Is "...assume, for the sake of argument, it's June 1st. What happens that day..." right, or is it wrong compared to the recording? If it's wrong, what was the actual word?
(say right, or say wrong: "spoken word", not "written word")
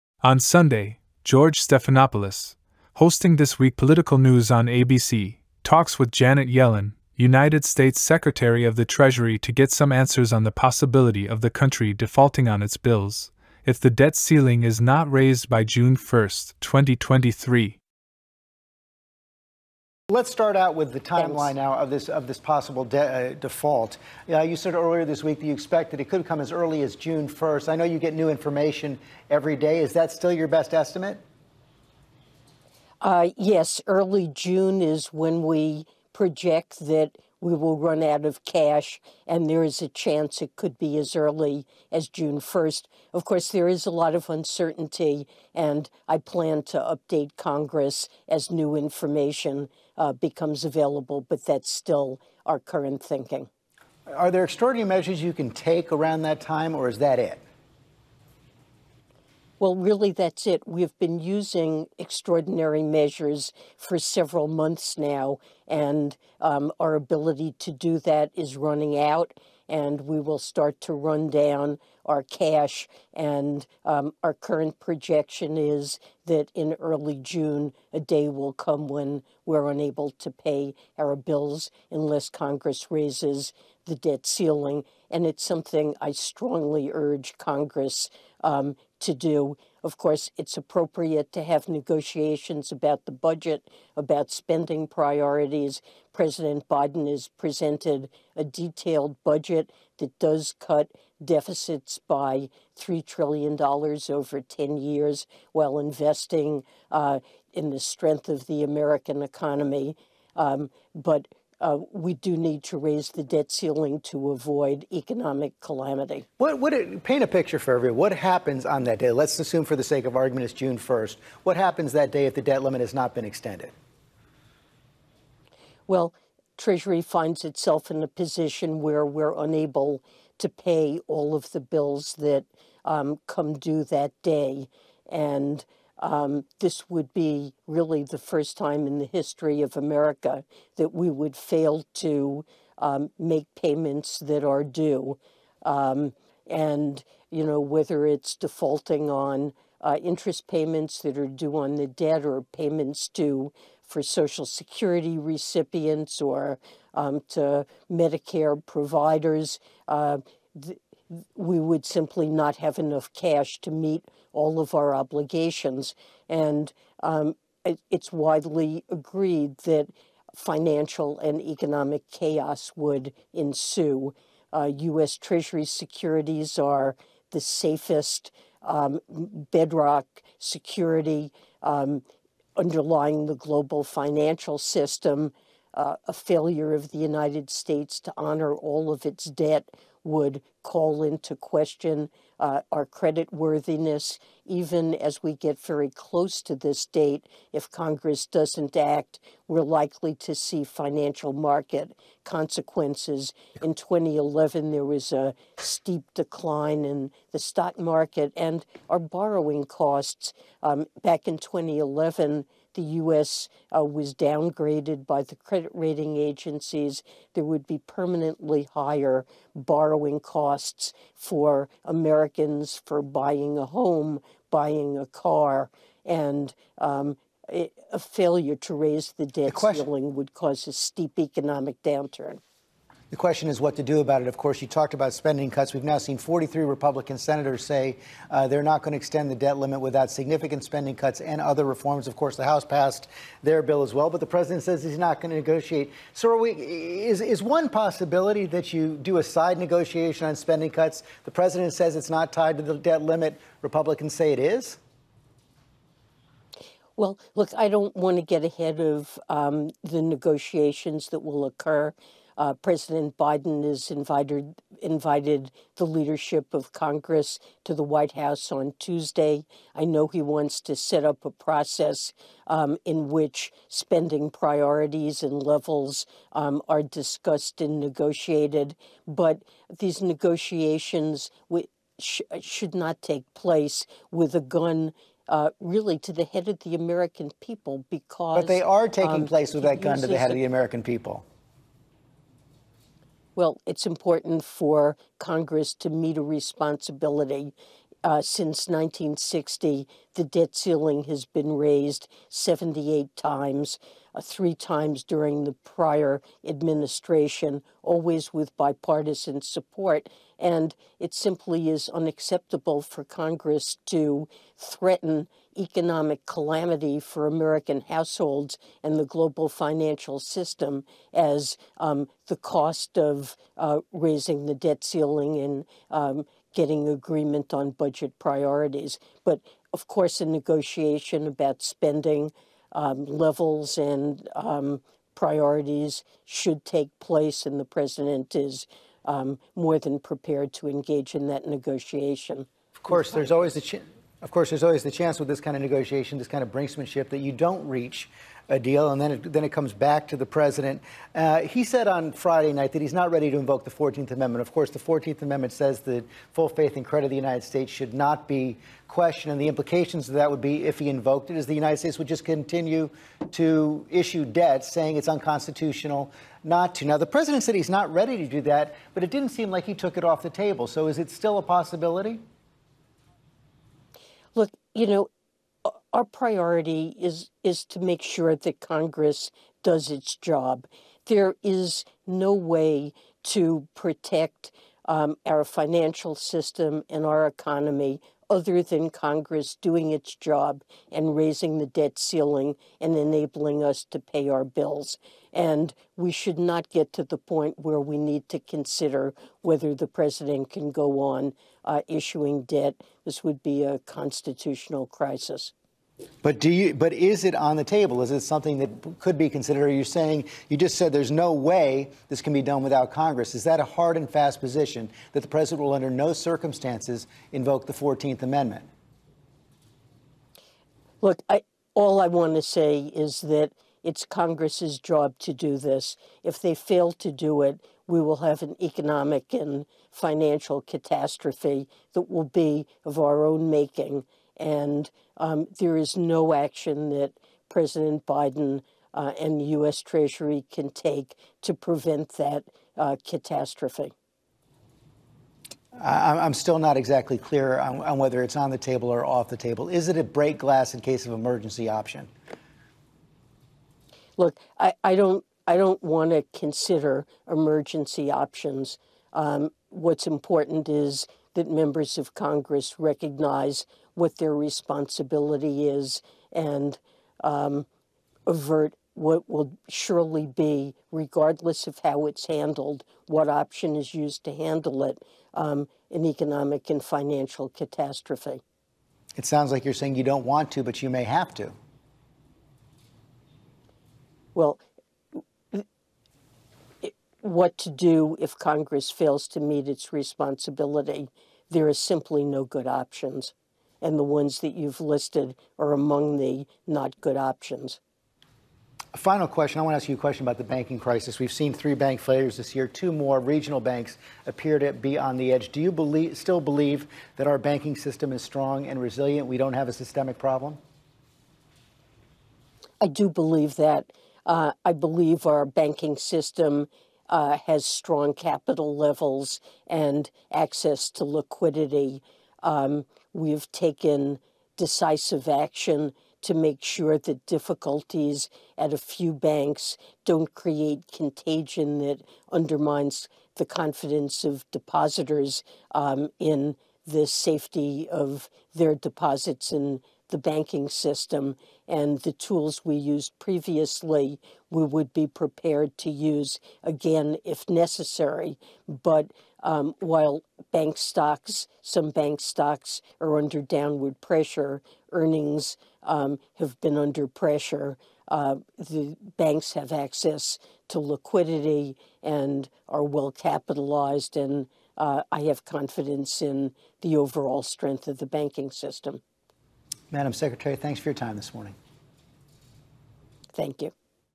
right.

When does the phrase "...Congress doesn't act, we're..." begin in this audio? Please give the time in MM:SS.
03:17.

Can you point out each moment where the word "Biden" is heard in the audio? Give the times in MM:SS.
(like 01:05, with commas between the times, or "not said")
01:36, 04:23, 07:18.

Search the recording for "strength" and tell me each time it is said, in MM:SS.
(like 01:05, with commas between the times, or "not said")
01:47, 09:27.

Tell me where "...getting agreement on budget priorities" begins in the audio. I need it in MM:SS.
05:26.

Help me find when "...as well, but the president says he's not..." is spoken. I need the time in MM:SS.
04:03.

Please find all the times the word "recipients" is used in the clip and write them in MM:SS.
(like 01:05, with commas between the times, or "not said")
02:35.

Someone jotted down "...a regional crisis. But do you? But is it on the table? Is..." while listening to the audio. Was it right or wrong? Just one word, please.
wrong.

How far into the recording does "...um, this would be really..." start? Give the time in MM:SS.
02:16.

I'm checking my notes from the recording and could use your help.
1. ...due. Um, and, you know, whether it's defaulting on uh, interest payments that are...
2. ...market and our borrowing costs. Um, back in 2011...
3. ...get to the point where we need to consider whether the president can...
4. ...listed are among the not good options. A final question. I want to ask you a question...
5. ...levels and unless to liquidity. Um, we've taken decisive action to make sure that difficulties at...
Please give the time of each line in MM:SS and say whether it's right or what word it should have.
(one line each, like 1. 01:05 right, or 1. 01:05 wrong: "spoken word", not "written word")
1. 02:24 right
2. 03:27 right
3. 06:36 right
4. 08:14 right
5. 08:38 wrong: "access", not "unless".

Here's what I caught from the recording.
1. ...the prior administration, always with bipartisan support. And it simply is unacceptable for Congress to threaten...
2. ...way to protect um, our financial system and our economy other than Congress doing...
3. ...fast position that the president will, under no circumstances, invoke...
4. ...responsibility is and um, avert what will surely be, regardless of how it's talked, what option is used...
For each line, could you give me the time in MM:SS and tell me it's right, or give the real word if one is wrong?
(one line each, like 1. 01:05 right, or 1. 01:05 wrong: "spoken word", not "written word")
1. 05:05 right
2. 06:22 right
3. 06:54 right
4. 07:44 wrong: "handled", not "talked".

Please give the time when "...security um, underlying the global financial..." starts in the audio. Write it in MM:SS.
03:00.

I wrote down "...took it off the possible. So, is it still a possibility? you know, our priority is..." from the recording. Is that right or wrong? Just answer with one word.
wrong.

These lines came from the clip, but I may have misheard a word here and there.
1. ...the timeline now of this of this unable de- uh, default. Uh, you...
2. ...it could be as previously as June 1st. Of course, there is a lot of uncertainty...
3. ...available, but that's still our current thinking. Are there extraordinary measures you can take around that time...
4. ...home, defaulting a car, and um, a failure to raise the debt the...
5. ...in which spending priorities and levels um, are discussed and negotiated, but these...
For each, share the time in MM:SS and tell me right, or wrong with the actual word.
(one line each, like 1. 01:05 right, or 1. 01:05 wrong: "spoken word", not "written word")
1. 00:20 wrong: "possible", not "unable"
2. 00:40 wrong: "early", not "previously"
3. 00:50 right
4. 03:43 wrong: "buying", not "defaulting"
5. 04:32 right.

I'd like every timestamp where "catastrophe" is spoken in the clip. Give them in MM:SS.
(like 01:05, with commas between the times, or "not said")
07:10, 07:23, 07:57.